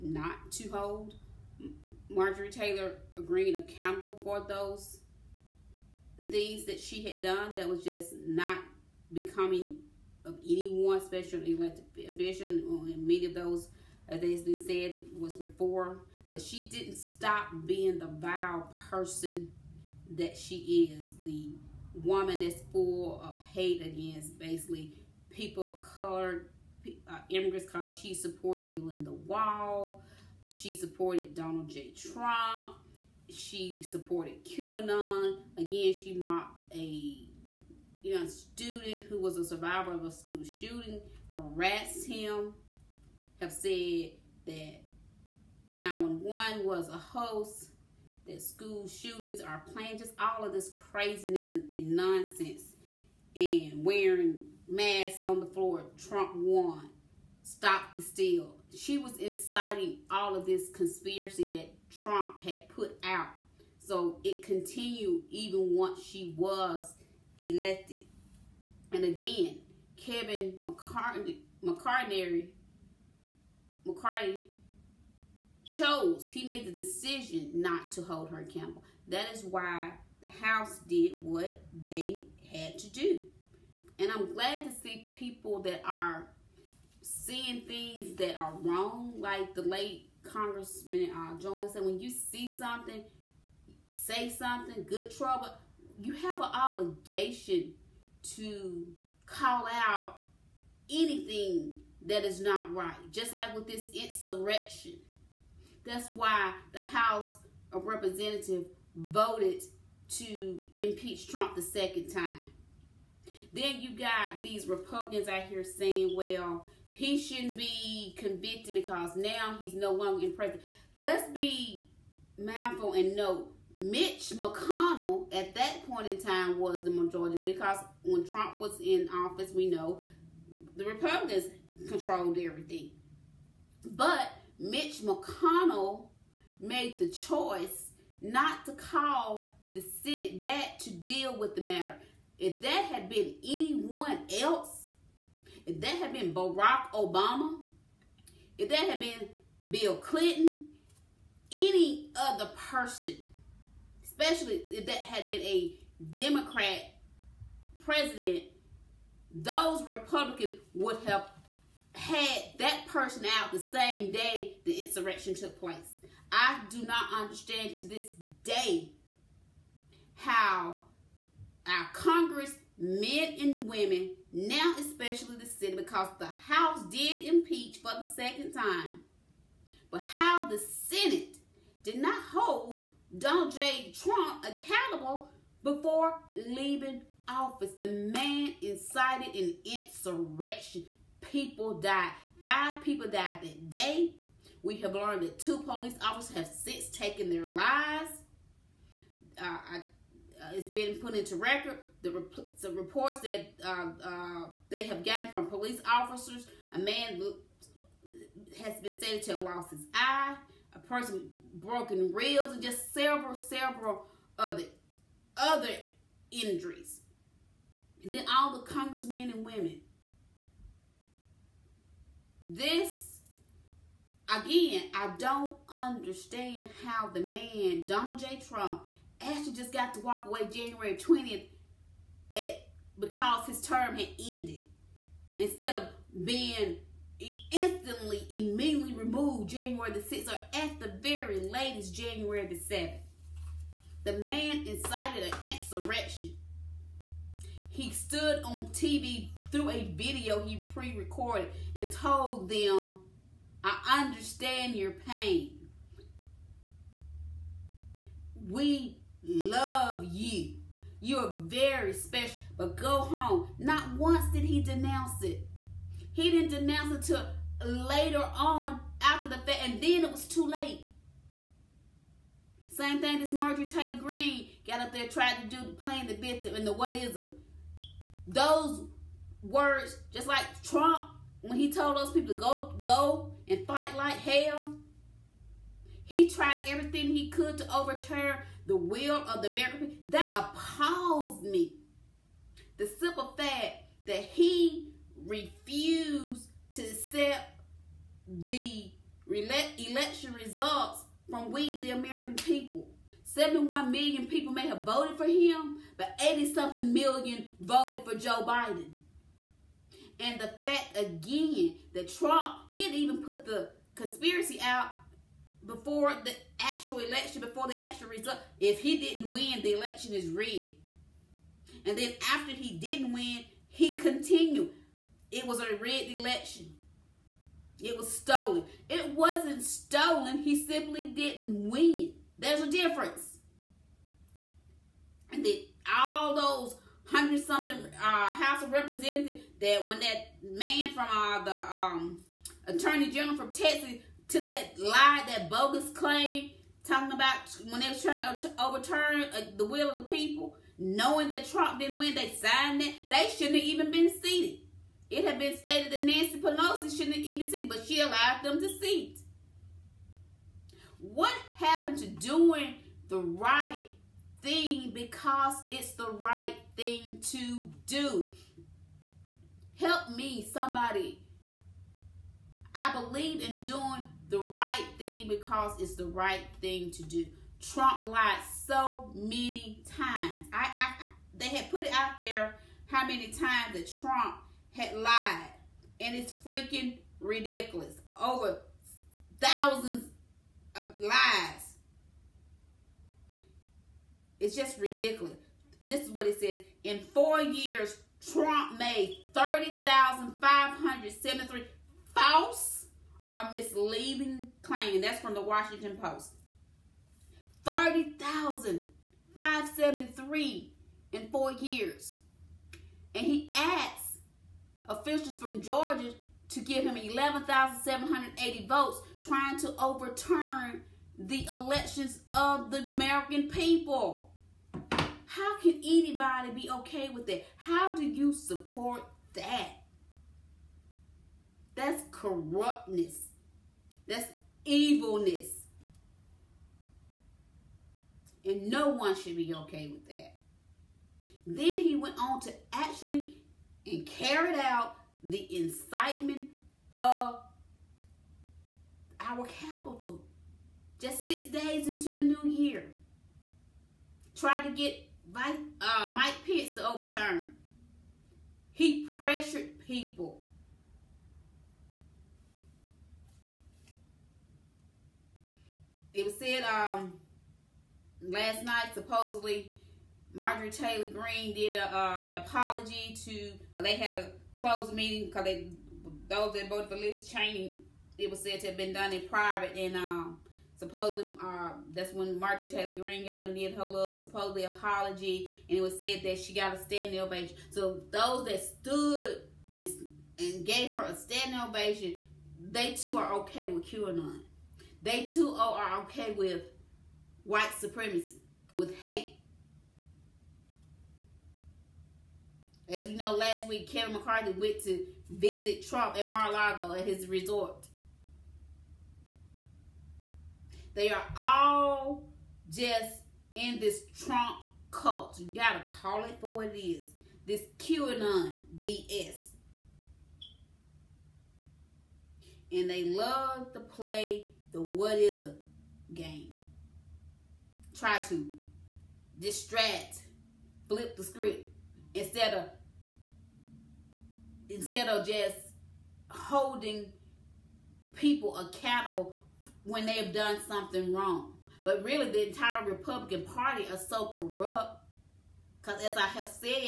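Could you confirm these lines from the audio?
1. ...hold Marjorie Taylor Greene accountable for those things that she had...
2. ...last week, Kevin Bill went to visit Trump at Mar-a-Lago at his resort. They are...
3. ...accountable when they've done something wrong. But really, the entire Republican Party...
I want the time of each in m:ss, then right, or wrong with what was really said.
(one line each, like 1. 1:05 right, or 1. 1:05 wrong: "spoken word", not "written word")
1. 0:00 right
2. 8:23 wrong: "McCarthy", not "Bill"
3. 8:58 right.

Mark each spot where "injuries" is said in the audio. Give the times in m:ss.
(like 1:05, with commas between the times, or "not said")
3:36.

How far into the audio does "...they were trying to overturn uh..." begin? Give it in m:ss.
5:47.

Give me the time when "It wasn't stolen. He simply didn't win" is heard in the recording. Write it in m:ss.
5:28.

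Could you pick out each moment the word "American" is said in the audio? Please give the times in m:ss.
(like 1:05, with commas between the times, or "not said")
4:49, 5:01, 7:02.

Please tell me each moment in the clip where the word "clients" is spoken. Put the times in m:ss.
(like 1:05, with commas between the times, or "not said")
not said.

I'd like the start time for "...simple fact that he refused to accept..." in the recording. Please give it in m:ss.
4:52.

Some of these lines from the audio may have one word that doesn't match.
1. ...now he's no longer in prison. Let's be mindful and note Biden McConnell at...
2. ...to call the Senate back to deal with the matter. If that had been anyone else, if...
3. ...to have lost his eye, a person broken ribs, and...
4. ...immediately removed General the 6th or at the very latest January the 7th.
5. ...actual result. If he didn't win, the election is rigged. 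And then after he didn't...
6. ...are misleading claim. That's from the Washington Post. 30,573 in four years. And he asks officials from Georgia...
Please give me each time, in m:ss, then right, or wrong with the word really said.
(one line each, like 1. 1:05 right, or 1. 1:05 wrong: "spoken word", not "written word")
1. 1:59 wrong: "Mitch", not "Biden"
2. 2:18 right
3. 3:29 right
4. 3:58 wrong: "January", not "General"
5. 5:17 right
6. 6:43 right.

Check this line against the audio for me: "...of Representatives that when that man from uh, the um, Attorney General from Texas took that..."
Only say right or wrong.
right.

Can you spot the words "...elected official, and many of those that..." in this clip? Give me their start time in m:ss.
0:11.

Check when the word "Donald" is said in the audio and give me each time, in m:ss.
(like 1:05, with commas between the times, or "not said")
0:31, 3:03, 3:47.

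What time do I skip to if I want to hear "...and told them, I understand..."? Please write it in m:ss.
4:11.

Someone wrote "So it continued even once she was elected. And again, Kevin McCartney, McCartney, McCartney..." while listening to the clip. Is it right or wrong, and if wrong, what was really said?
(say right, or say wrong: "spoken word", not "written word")
right.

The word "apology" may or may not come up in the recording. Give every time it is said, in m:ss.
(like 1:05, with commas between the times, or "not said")
7:52, 8:04.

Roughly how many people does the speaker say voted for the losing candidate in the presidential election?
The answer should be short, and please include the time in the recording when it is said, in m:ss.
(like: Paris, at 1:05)
71 million, at 5:03.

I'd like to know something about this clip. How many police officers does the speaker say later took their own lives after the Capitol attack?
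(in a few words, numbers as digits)
2.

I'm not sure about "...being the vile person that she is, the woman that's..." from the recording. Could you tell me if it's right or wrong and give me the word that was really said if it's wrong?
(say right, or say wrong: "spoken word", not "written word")
right.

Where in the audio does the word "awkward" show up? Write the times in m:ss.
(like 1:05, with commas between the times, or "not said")
not said.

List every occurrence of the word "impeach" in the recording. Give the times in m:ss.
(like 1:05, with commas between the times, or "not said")
1:50, 2:57.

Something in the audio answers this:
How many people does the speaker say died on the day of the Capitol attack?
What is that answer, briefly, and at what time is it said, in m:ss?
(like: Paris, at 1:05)
5, at 3:12.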